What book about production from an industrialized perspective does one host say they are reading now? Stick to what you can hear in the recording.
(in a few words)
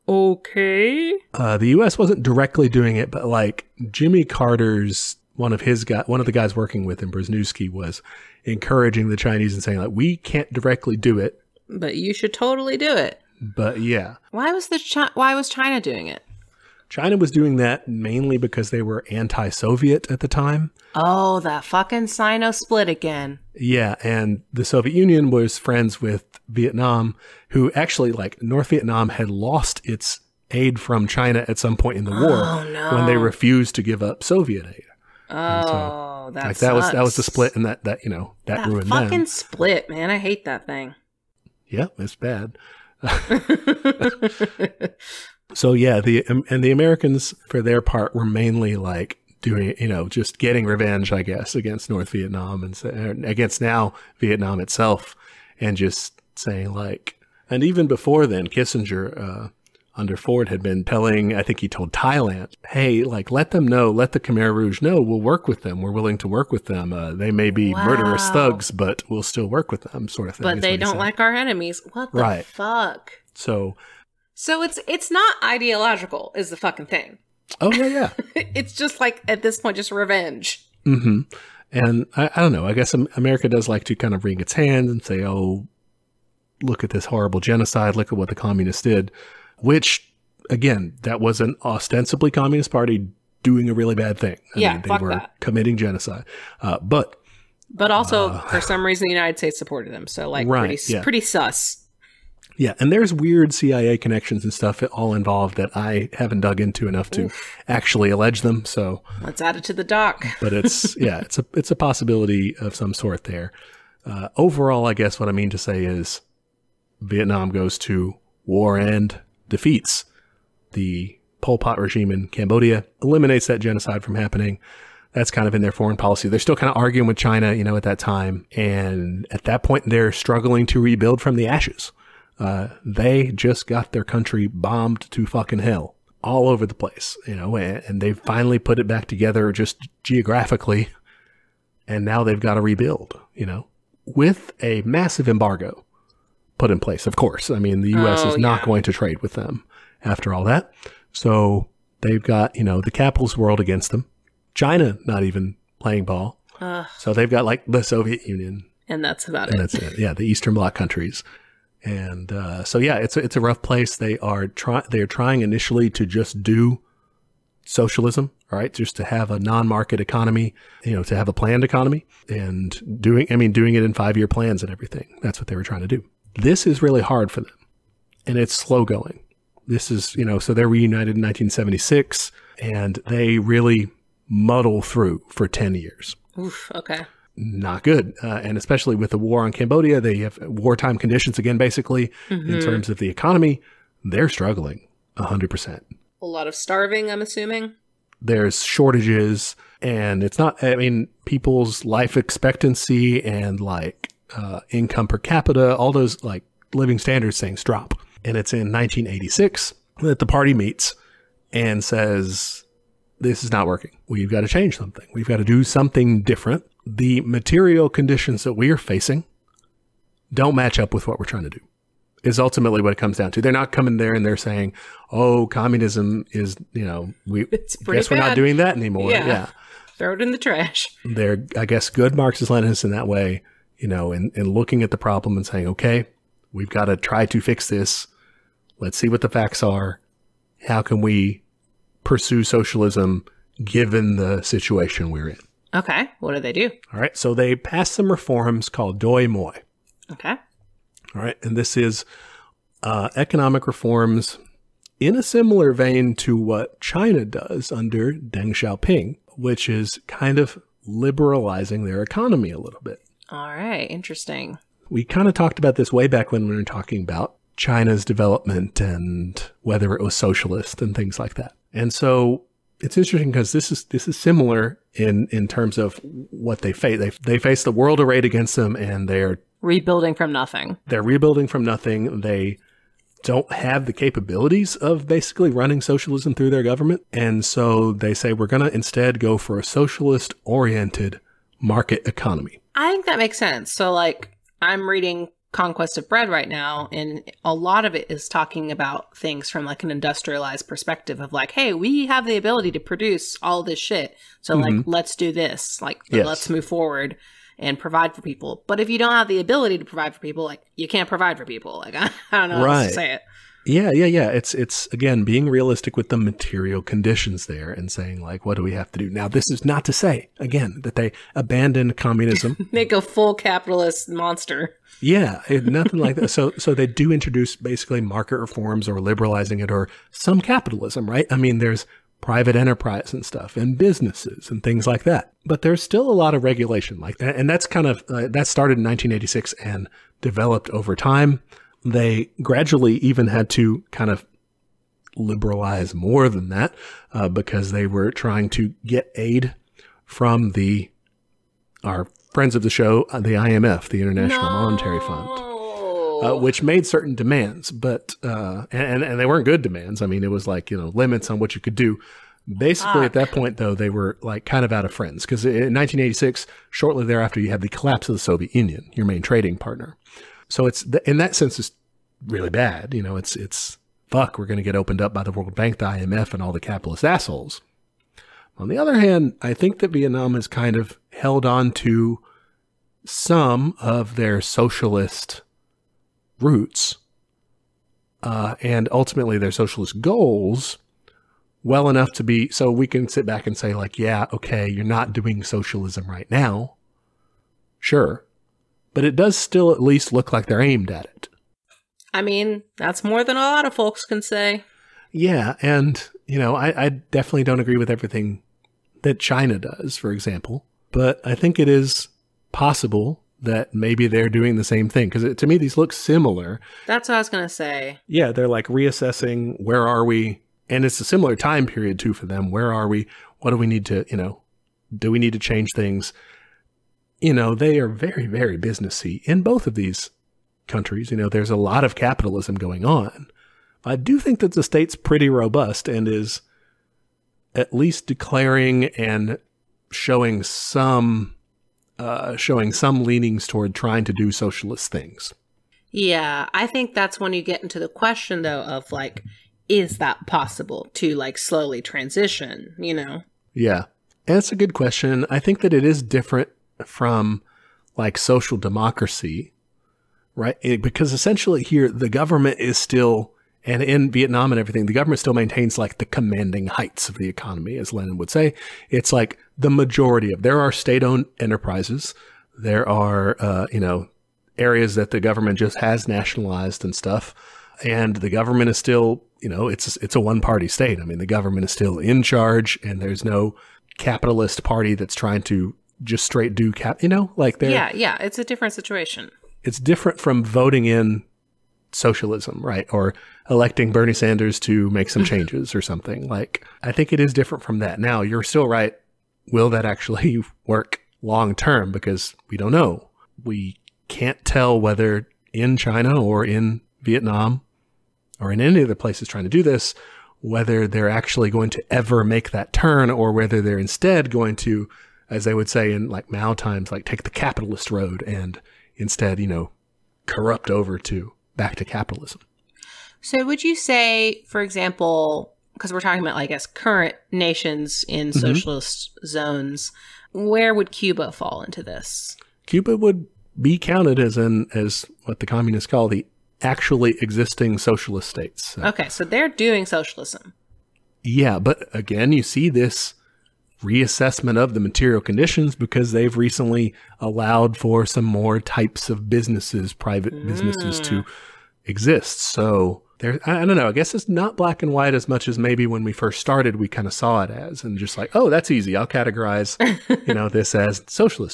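Conquest of Bread.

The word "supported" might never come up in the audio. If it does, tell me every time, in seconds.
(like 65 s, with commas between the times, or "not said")
99 s.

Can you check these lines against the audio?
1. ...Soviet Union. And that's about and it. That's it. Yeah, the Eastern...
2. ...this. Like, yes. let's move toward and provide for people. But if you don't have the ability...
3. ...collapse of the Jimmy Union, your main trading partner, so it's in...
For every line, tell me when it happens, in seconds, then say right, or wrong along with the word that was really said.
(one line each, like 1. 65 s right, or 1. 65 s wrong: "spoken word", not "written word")
1. 157 s right
2. 305 s wrong: "forward", not "toward"
3. 367 s wrong: "Soviet", not "Jimmy".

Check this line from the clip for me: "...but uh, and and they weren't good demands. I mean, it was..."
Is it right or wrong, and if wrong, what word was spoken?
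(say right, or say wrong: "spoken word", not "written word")
right.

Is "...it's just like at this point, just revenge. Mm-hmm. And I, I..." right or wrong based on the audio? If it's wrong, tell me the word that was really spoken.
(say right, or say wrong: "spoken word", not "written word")
right.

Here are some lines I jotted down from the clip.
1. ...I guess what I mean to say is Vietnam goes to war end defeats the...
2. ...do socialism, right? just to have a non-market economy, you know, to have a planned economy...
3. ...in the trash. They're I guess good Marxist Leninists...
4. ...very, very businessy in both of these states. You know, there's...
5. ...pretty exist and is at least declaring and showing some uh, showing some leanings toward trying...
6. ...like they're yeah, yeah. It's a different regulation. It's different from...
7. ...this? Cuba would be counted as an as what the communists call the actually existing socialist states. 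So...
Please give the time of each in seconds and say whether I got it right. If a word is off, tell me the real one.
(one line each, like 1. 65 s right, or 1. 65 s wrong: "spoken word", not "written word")
1. 114 s right
2. 166 s right
3. 230 s right
4. 427 s wrong: "countries", not "states"
5. 434 s wrong: "robust", not "exist"
6. 487 s wrong: "situation", not "regulation"
7. 531 s right.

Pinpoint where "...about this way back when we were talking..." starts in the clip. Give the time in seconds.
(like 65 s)
265 s.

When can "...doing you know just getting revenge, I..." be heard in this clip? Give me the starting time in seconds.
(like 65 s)
49 s.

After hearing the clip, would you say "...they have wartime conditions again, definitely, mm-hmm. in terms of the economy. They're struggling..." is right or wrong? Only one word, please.
wrong.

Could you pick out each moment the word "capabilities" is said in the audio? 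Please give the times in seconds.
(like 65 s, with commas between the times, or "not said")
283 s.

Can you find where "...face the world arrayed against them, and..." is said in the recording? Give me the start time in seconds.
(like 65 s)
277 s.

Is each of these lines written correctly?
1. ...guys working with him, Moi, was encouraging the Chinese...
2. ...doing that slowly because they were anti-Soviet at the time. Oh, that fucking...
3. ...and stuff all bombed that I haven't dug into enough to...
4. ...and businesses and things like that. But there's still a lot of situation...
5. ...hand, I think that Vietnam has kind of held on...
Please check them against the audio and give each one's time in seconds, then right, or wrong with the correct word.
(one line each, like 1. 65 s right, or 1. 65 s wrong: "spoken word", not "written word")
1. 6 s wrong: "Brzezinski", not "Moi"
2. 17 s wrong: "mainly", not "slowly"
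3. 104 s wrong: "involved", not "bombed"
4. 333 s wrong: "regulation", not "situation"
5. 378 s right.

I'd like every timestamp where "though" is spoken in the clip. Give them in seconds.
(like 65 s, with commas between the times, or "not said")
363 s, 448 s.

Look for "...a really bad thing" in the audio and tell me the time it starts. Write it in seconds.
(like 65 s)
93 s.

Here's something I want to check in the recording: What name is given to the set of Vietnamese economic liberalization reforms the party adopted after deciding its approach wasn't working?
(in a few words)
Doi Moi.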